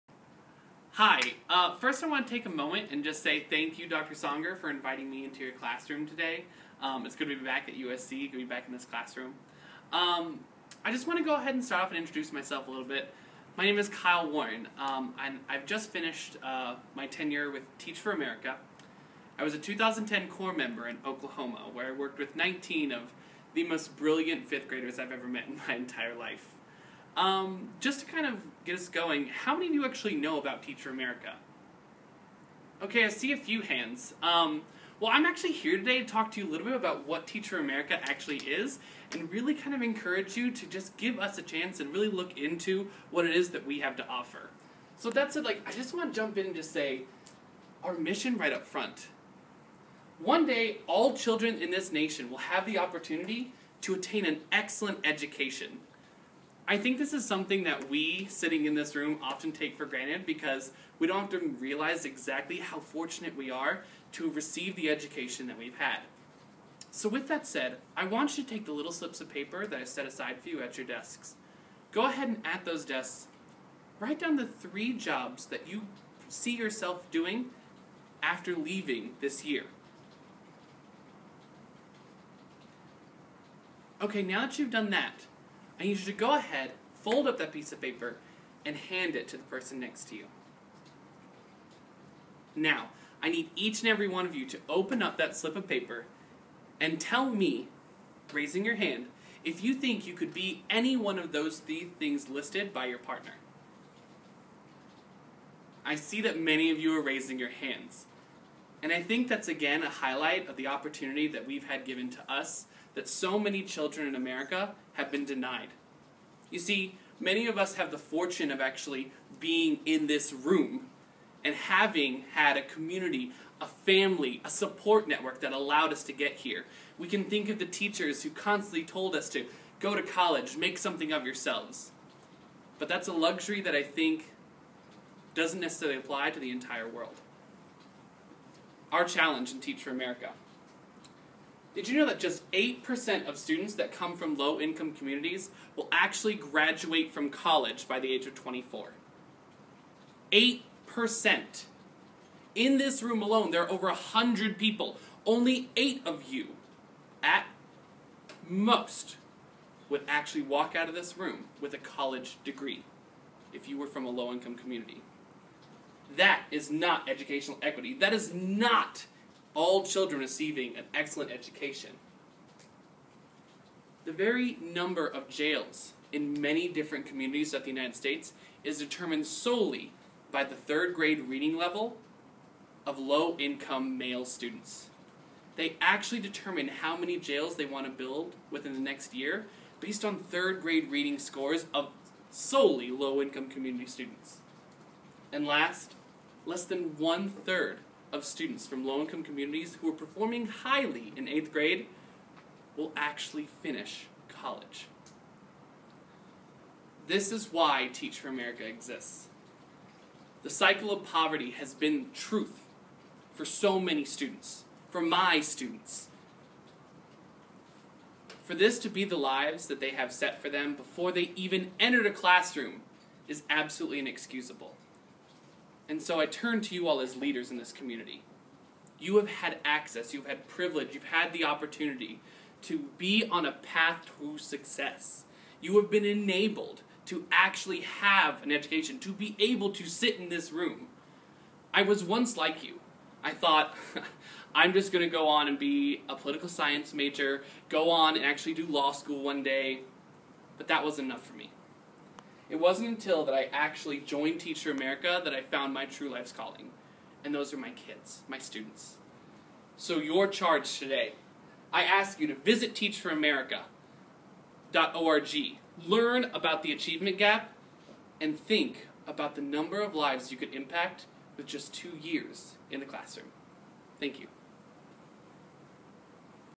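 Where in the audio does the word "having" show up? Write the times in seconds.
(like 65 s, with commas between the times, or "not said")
121 s.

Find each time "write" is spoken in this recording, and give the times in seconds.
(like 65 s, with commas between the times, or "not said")
73 s.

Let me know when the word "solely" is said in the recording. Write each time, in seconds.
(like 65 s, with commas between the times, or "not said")
179 s, 192 s.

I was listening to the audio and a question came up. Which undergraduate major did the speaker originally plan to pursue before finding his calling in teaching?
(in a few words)
political science.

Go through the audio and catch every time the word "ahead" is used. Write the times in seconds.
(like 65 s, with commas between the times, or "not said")
11 s, 72 s, 86 s.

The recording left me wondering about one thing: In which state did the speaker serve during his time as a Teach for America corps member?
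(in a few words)
Oklahoma.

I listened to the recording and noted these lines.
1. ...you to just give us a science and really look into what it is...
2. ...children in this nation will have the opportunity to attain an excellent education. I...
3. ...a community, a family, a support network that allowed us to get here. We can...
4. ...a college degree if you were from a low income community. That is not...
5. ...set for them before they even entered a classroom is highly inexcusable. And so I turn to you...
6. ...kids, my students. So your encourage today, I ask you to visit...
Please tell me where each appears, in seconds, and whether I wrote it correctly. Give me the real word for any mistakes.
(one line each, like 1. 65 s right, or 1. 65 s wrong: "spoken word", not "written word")
1. 40 s wrong: "chance", not "science"
2. 51 s right
3. 122 s right
4. 161 s right
5. 220 s wrong: "absolutely", not "highly"
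6. 257 s wrong: "charge", not "encourage".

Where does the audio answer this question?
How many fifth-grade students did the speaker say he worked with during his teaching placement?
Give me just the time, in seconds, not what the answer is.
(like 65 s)
22 s.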